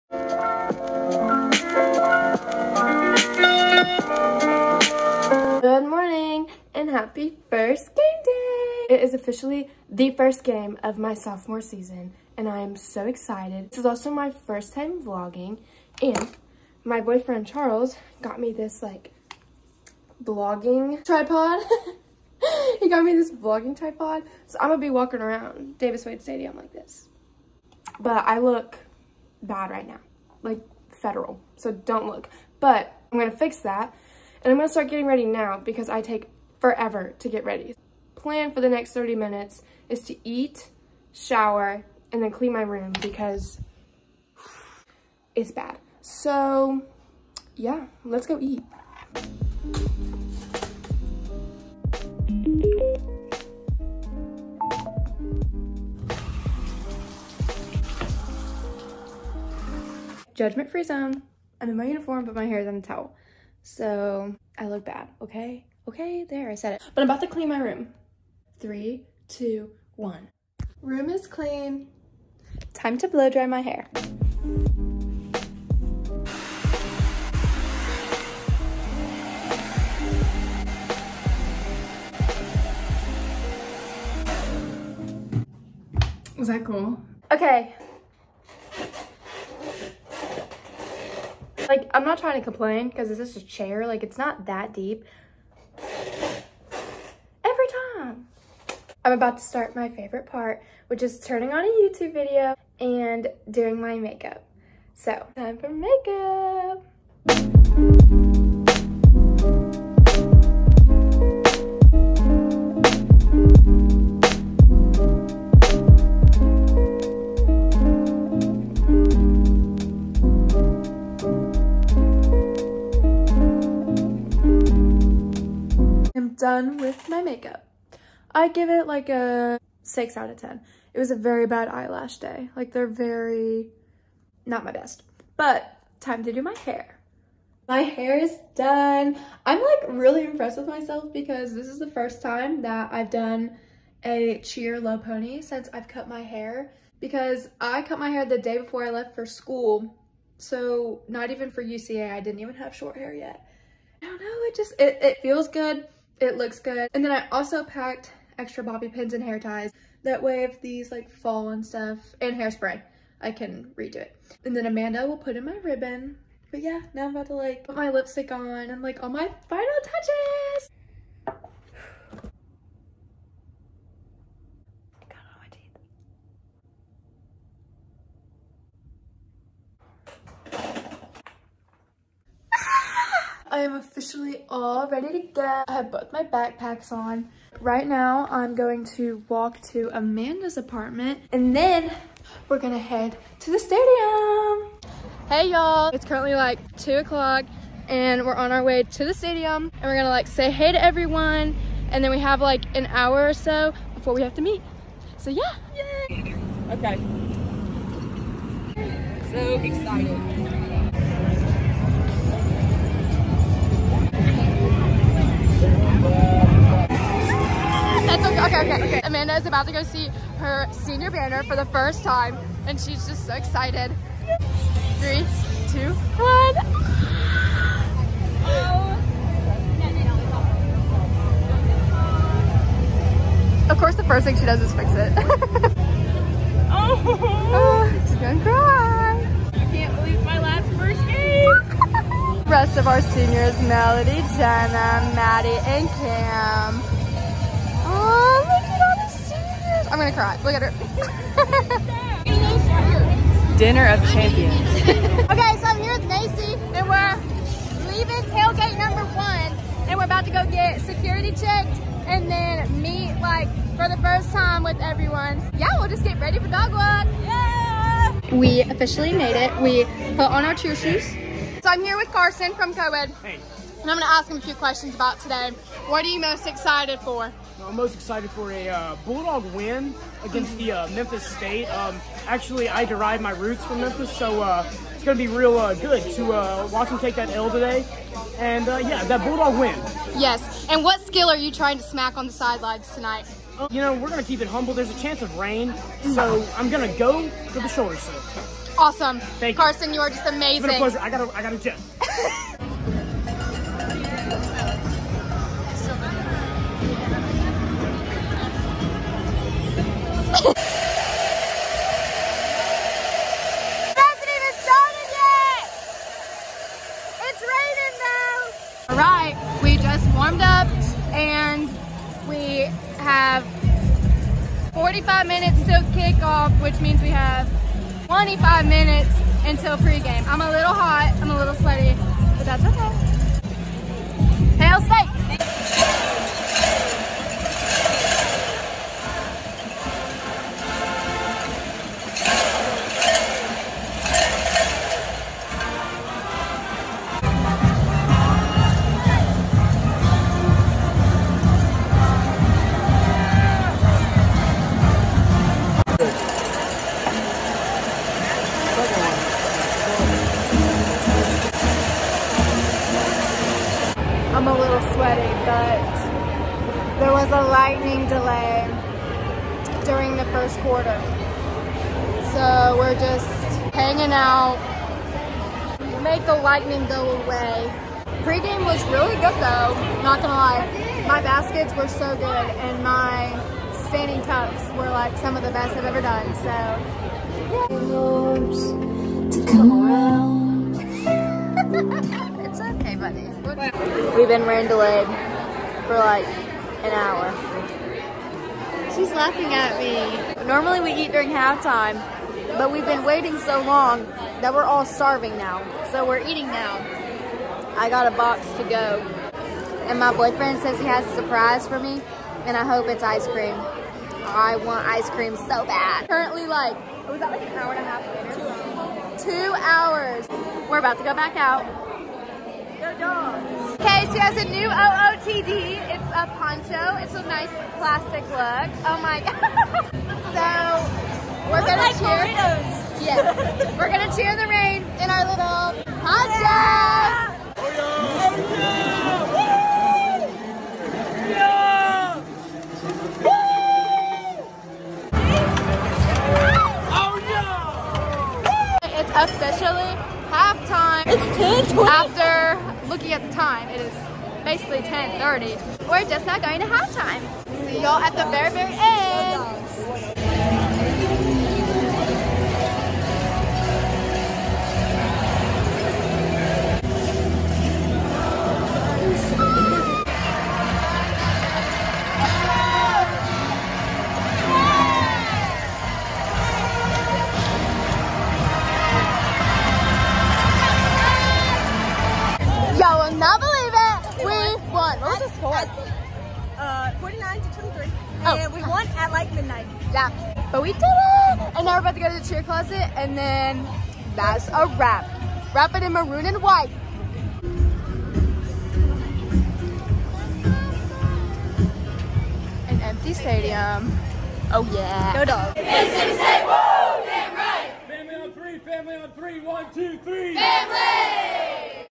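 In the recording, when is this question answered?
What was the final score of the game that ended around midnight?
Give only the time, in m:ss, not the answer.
8:07.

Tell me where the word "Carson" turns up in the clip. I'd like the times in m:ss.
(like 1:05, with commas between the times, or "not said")
4:32, 4:59.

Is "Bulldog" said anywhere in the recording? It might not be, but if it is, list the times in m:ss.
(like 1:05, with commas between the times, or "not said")
4:39, 4:49.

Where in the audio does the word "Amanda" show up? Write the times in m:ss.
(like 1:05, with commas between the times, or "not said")
2:44, 3:09, 3:39.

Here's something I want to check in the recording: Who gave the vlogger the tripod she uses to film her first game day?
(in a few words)
Charles.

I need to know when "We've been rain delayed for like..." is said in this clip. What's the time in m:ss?
6:34.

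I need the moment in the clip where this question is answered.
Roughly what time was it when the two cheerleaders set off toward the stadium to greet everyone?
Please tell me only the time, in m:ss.
3:16.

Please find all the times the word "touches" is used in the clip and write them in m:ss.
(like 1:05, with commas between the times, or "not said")
2:49.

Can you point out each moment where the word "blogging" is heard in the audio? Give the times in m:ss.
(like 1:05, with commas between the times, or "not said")
0:20.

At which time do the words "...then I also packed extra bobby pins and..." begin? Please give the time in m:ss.
2:37.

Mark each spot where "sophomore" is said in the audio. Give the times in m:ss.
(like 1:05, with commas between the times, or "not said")
0:11.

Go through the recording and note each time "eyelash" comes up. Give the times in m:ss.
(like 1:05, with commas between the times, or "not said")
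2:11.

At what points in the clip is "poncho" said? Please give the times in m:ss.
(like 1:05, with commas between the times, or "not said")
7:06, 7:15.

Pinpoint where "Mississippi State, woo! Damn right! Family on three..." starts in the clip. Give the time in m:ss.
8:25.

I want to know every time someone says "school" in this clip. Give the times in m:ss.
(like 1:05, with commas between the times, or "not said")
2:29.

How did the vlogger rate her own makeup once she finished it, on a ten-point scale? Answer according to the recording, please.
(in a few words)
6.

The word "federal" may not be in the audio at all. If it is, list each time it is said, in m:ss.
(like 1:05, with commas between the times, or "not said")
0:30.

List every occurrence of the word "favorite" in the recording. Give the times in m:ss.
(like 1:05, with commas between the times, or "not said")
1:39.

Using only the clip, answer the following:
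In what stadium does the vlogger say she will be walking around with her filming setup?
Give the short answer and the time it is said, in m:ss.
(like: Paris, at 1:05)
Davis Wade Stadium, at 0:25.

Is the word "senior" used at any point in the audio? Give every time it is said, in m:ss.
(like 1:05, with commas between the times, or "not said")
3:40, 4:03.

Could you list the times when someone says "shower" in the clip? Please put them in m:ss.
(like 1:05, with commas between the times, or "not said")
0:41.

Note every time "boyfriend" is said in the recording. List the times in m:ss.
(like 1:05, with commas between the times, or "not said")
0:16, 6:50.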